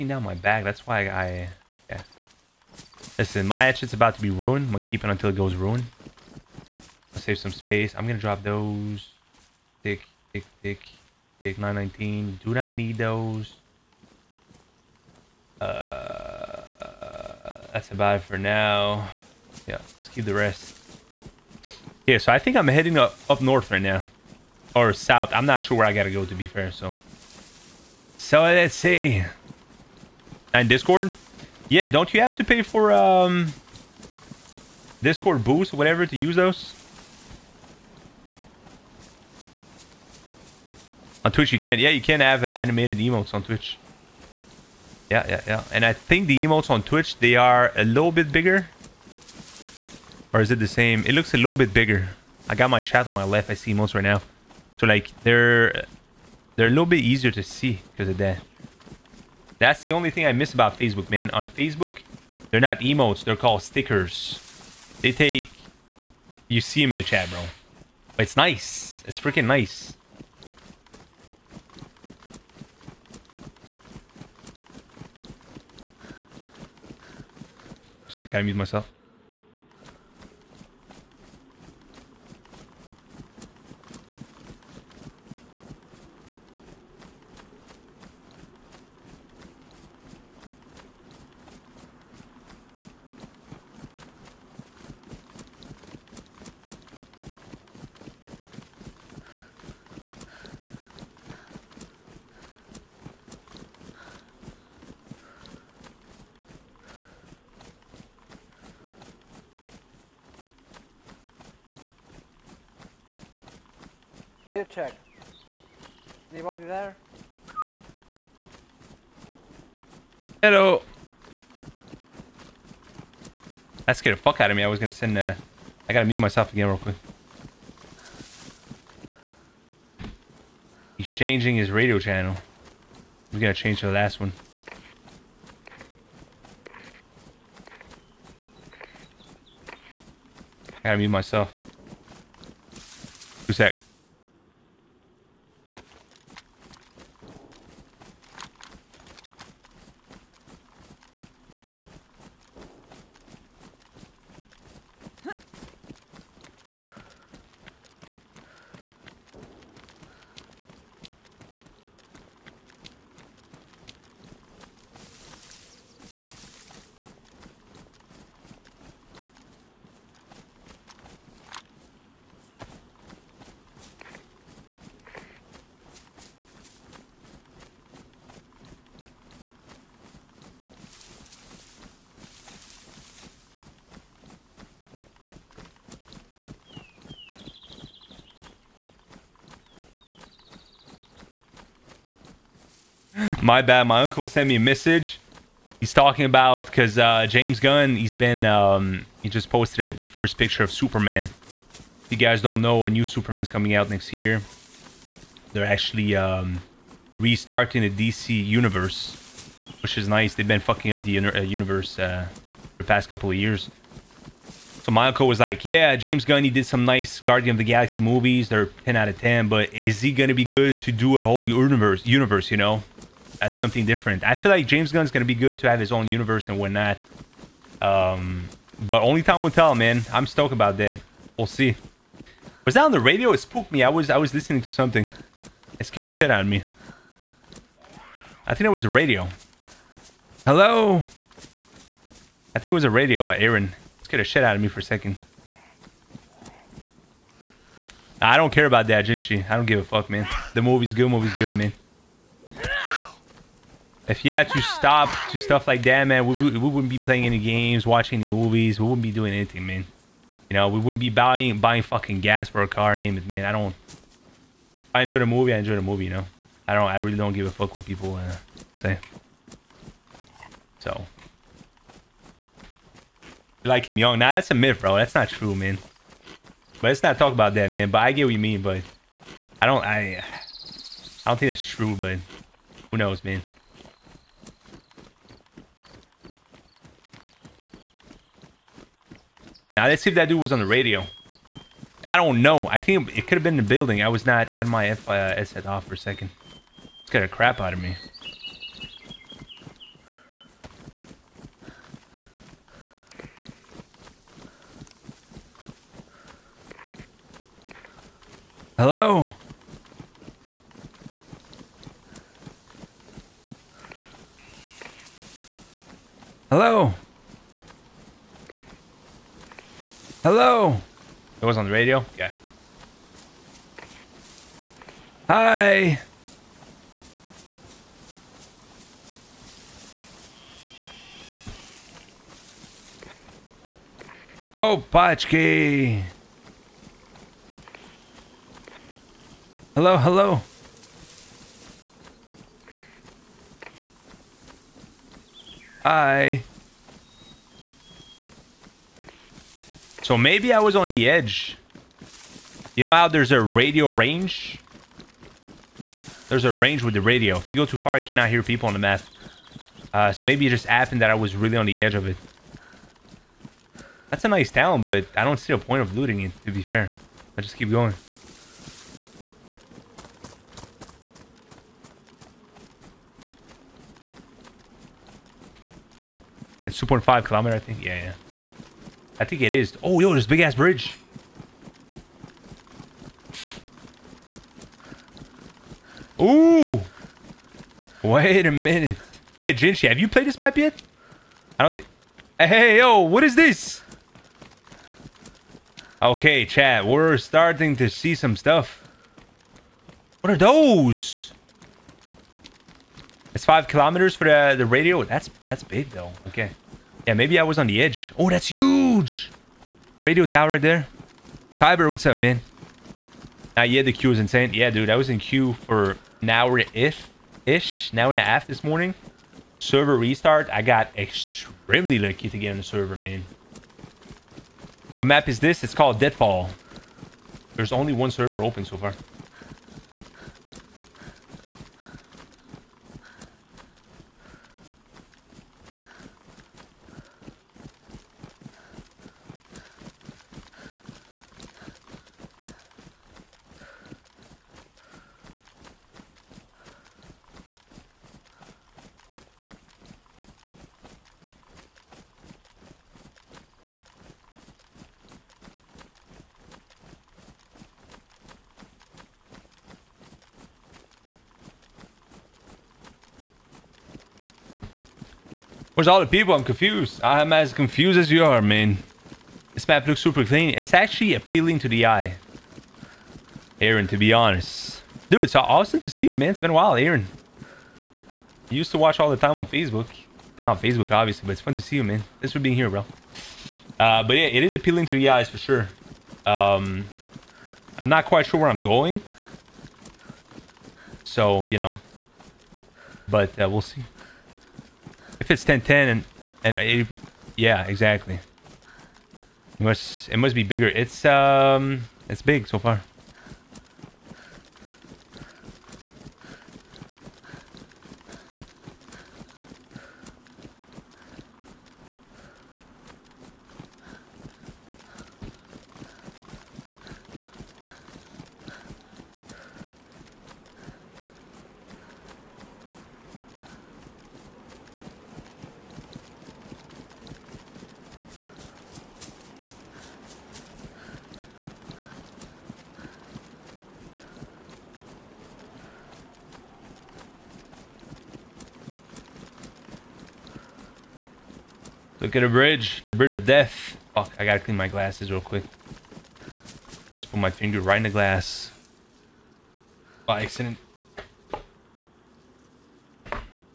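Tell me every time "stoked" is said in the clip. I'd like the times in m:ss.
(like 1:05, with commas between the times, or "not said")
3:50.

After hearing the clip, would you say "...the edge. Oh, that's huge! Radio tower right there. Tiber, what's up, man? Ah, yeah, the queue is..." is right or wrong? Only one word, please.
right.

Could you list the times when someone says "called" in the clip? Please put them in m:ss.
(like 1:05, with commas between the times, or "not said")
1:03, 7:05.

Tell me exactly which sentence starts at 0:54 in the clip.
So like they're they're a little bit easier to see because of that.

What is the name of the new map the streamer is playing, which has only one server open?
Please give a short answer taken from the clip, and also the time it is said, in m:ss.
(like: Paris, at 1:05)
Deadfall, at 7:05.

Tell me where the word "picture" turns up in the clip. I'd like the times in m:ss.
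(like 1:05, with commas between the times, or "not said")
3:20.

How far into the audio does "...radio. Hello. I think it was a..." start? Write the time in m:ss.
3:58.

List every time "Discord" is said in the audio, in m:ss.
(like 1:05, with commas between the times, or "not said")
0:30, 0:35.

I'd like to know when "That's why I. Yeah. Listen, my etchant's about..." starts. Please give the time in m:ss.
0:00.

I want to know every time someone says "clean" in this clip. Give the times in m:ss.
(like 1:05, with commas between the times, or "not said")
7:50, 9:04.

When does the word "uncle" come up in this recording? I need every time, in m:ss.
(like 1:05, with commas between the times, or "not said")
3:14, 3:35.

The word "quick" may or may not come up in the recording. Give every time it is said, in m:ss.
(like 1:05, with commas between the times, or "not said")
2:06, 9:05.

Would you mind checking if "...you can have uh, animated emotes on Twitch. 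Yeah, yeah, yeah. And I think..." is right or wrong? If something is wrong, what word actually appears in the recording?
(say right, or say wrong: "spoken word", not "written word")
right.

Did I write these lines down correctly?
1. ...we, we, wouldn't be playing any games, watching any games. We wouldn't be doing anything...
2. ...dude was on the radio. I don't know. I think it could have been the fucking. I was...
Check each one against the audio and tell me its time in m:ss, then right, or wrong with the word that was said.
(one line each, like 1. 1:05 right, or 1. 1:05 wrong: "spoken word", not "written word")
1. 4:16 wrong: "movies", not "games"
2. 4:50 wrong: "building", not "fucking".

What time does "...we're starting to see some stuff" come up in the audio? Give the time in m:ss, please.
6:36.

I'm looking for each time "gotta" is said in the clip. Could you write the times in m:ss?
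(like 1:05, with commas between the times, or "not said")
0:25, 1:18, 2:05, 2:13, 2:20, 9:04.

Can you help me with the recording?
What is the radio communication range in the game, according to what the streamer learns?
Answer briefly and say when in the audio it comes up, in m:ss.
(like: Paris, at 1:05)
5 kilometers, at 6:43.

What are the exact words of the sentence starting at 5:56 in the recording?
There's a range with the radio.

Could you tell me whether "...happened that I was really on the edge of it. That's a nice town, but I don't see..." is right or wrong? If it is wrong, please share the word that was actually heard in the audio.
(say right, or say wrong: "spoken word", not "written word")
right.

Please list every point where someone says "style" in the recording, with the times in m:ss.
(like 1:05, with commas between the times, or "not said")
not said.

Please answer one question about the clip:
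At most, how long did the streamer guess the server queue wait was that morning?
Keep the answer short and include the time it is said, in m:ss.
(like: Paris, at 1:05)
an hour and a half, at 6:57.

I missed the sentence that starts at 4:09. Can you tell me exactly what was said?
I don't give a fuck, man.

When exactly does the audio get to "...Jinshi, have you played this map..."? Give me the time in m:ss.
6:29.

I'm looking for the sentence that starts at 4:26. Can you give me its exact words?
I really don't give a fuck what people uh, say.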